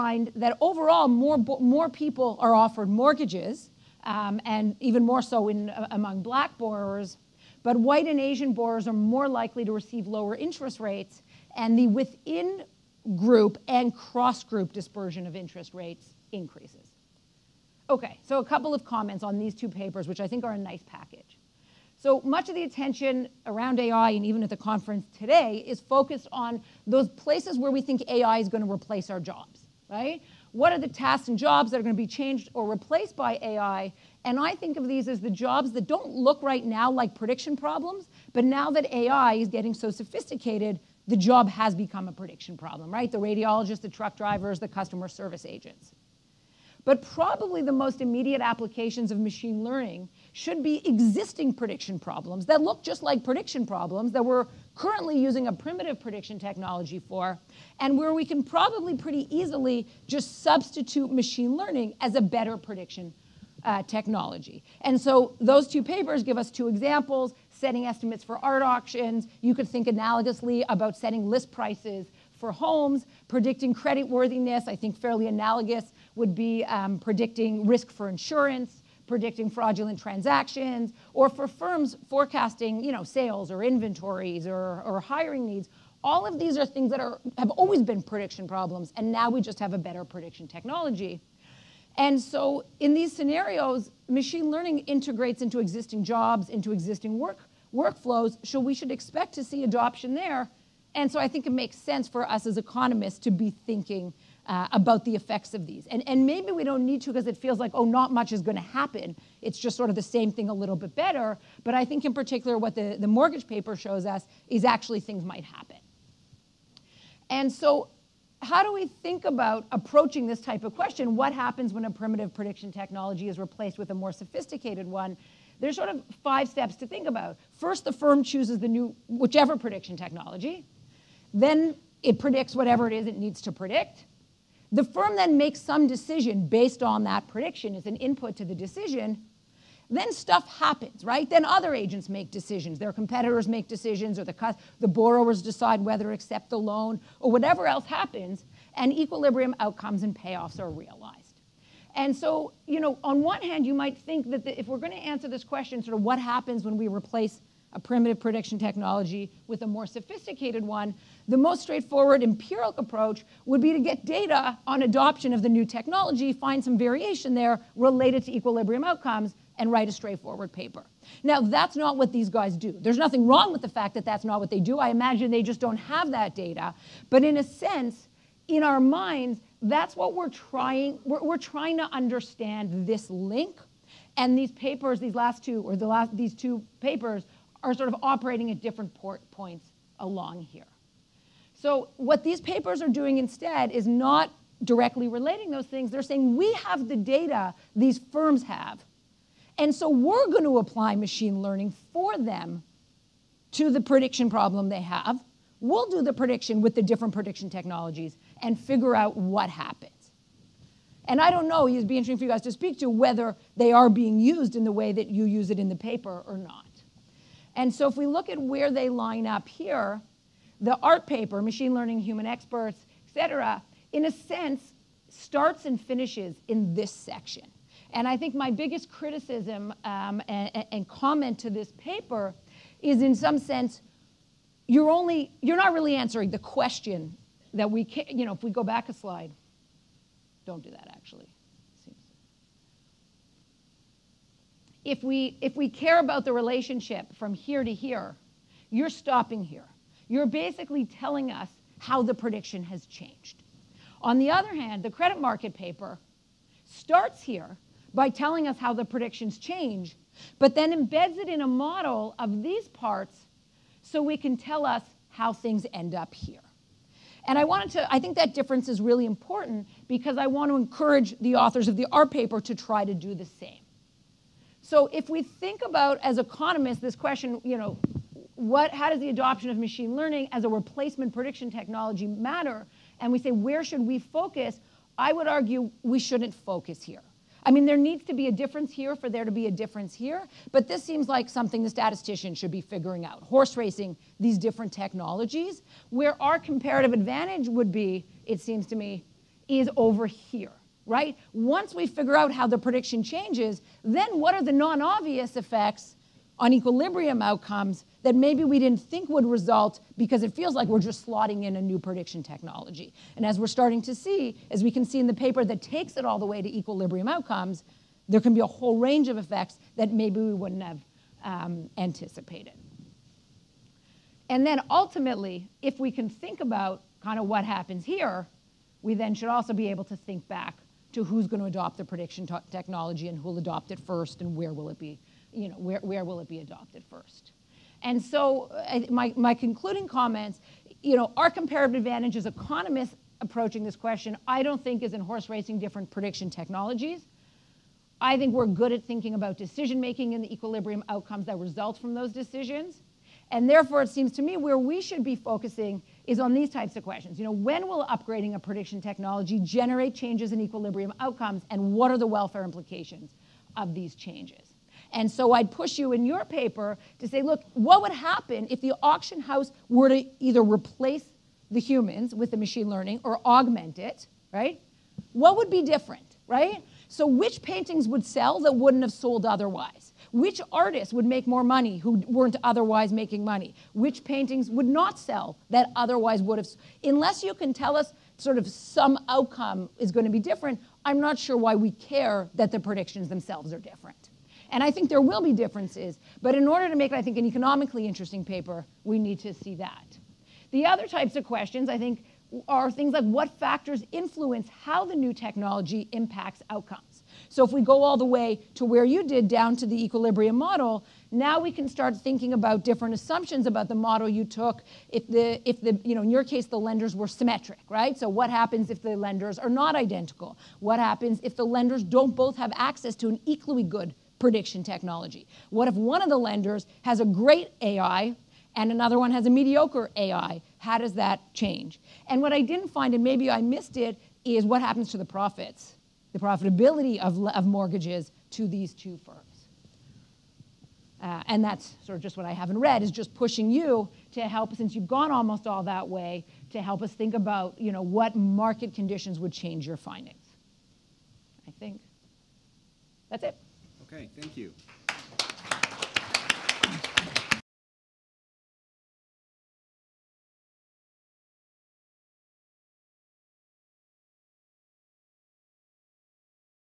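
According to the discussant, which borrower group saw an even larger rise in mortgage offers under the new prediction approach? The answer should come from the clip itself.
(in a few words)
Black borrowers.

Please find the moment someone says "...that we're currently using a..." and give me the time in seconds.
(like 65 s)
54 s.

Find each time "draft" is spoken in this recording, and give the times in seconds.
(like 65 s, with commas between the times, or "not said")
not said.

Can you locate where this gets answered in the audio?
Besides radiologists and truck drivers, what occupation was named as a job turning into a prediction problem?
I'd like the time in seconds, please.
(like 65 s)
44 s.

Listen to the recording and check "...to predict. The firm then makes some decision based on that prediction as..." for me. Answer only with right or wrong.
right.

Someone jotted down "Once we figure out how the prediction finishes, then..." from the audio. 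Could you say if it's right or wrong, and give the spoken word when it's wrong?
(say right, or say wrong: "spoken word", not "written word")
wrong: "changes", not "finishes".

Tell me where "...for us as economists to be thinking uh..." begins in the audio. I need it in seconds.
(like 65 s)
102 s.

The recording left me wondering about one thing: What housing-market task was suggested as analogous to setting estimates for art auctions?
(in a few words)
Setting list prices for homes.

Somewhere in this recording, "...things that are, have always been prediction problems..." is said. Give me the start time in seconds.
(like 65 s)
86 s.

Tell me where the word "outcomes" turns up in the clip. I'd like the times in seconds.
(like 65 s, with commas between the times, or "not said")
149 s, 168 s, 307 s, 317 s, 350 s, 361 s, 389 s, 406 s.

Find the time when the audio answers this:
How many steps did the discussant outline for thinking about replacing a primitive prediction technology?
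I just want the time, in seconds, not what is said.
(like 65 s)
126 s.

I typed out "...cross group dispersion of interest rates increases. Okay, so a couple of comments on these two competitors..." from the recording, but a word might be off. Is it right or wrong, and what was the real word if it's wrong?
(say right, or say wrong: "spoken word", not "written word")
wrong: "papers", not "competitors".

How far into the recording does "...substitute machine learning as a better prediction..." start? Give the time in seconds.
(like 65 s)
60 s.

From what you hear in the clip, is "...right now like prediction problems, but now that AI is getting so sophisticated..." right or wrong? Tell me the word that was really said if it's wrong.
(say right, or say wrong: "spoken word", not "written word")
right.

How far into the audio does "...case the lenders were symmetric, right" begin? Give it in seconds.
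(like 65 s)
416 s.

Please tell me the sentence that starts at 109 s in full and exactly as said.
It's just sort of the same thing a little bit better.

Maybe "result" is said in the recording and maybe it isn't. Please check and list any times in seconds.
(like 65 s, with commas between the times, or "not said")
309 s, 351 s.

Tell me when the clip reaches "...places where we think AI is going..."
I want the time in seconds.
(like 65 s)
27 s.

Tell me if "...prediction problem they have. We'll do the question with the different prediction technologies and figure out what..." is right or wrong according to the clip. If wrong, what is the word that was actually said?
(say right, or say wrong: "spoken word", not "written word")
wrong: "prediction", not "question".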